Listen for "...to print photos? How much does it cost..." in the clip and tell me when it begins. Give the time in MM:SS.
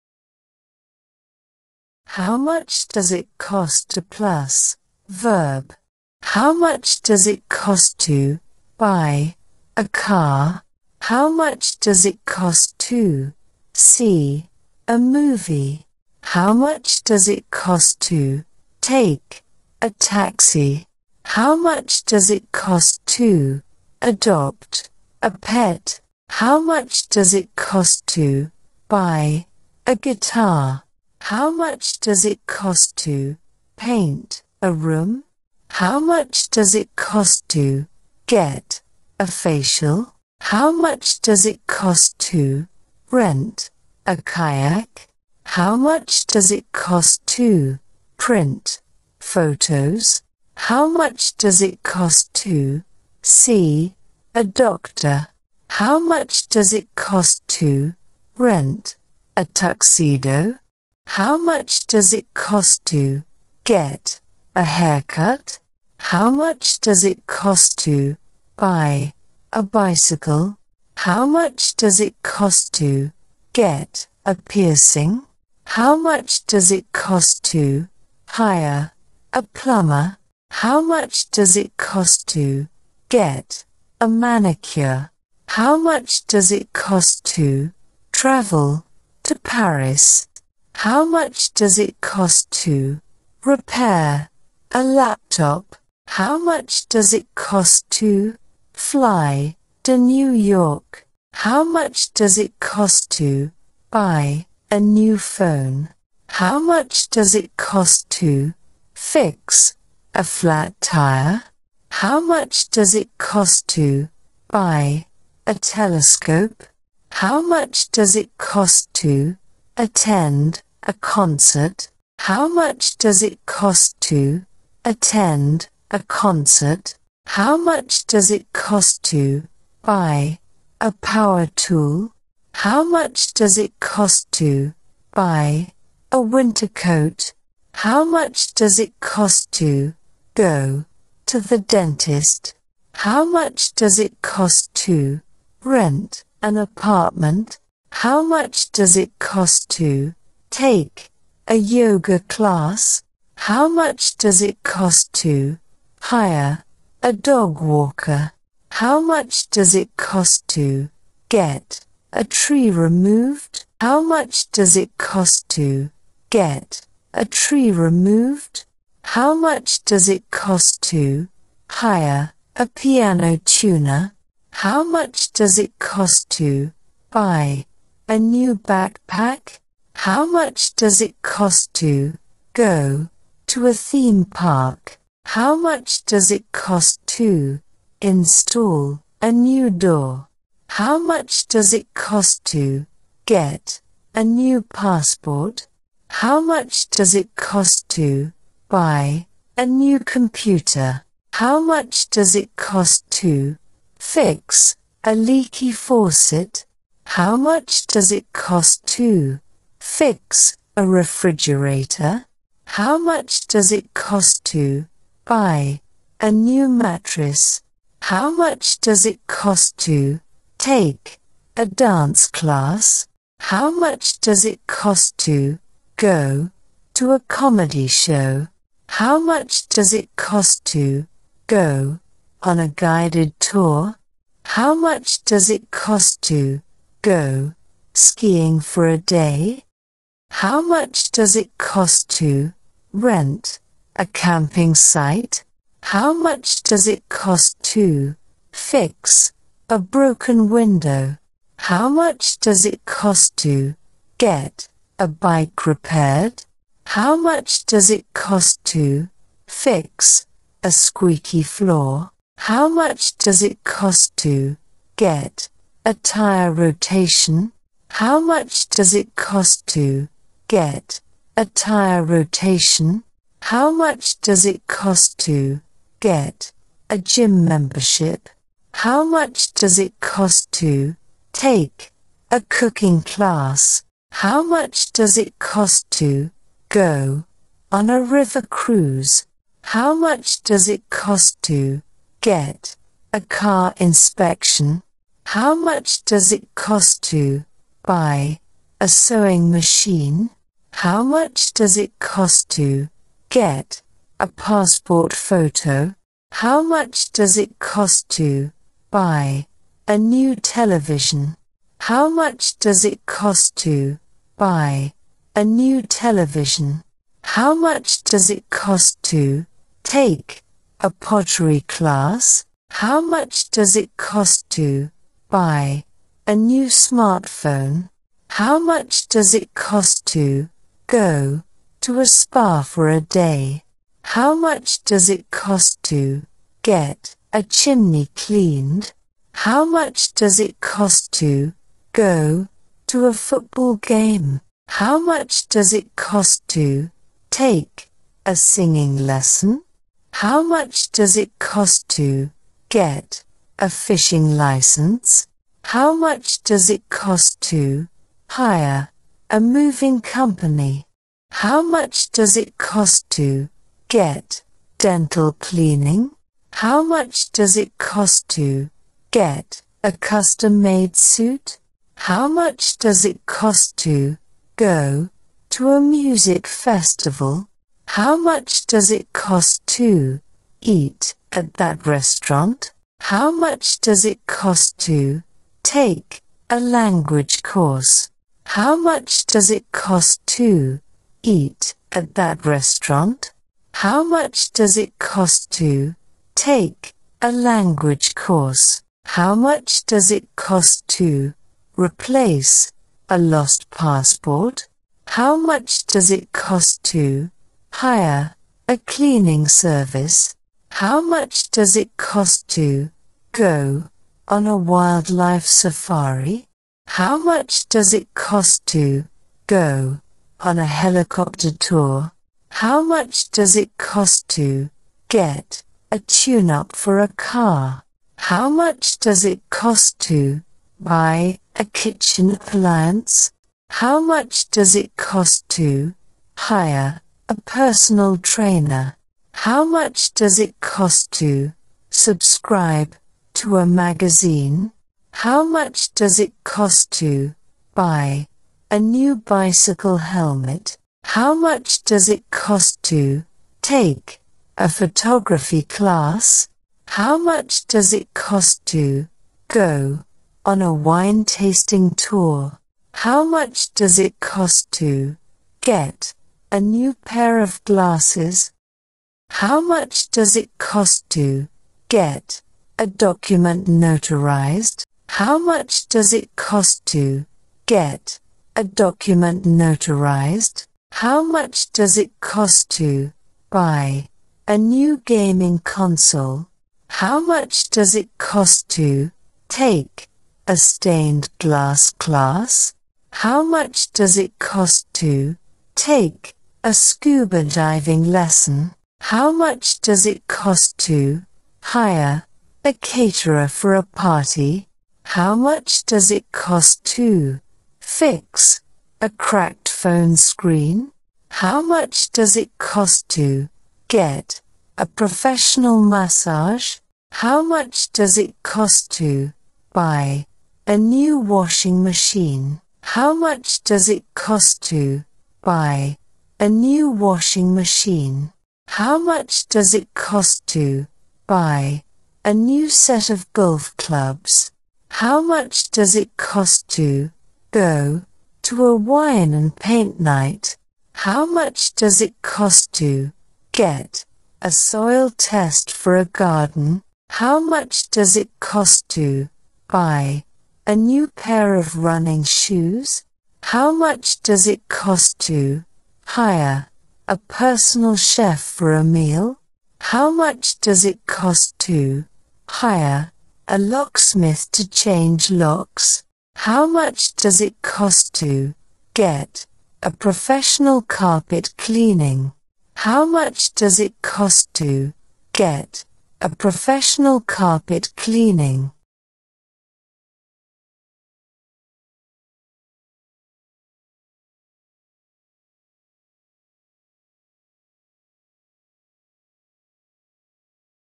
00:47.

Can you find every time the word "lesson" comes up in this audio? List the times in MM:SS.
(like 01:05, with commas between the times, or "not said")
05:49, 08:18.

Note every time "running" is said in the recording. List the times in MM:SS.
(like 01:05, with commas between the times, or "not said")
09:11.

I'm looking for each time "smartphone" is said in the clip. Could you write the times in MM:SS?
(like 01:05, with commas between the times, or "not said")
05:26.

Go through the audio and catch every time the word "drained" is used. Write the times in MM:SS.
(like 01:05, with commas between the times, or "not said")
not said.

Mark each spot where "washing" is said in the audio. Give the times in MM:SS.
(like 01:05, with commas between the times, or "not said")
08:41, 08:46.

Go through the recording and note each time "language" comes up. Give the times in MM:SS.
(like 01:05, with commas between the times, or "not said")
06:26, 06:37.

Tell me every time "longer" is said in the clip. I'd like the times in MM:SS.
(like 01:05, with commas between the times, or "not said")
not said.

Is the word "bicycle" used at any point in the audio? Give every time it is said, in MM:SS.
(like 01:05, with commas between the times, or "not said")
01:09, 07:29.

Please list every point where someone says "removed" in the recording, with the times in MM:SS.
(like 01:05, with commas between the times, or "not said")
02:42, 02:47.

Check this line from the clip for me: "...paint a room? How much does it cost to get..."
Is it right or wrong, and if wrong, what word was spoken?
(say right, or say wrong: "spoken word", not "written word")
right.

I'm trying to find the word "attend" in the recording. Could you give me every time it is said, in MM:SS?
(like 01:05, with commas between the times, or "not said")
01:59, 02:04.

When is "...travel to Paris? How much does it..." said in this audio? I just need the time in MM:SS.
01:28.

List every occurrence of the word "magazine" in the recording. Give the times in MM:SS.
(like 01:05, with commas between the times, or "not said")
07:23.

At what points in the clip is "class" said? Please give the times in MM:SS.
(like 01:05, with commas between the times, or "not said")
02:32, 03:42, 04:43, 05:21, 07:35, 08:11.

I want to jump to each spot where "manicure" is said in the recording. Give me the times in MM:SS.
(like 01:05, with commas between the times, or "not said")
01:24.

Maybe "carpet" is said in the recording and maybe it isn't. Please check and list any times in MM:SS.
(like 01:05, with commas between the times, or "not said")
09:30, 09:37.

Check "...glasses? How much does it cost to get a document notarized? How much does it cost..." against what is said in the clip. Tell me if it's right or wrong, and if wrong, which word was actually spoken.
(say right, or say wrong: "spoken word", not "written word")
right.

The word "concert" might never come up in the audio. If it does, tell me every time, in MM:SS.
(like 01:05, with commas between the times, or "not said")
02:00, 02:05.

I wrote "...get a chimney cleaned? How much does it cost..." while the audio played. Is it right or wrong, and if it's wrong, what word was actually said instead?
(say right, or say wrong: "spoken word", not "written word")
right.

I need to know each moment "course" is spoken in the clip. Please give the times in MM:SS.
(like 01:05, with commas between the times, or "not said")
06:27, 06:38.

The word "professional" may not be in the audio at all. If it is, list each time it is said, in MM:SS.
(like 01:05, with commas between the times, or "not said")
08:34, 09:29, 09:36.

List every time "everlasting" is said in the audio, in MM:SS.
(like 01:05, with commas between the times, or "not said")
not said.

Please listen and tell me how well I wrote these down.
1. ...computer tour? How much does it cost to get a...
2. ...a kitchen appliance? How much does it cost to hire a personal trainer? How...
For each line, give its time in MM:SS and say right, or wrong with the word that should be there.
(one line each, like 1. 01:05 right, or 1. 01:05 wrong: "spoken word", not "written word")
1. 07:00 wrong: "helicopter", not "computer"
2. 07:11 right.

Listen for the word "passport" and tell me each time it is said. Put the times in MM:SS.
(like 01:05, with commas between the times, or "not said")
03:14, 05:04, 06:43.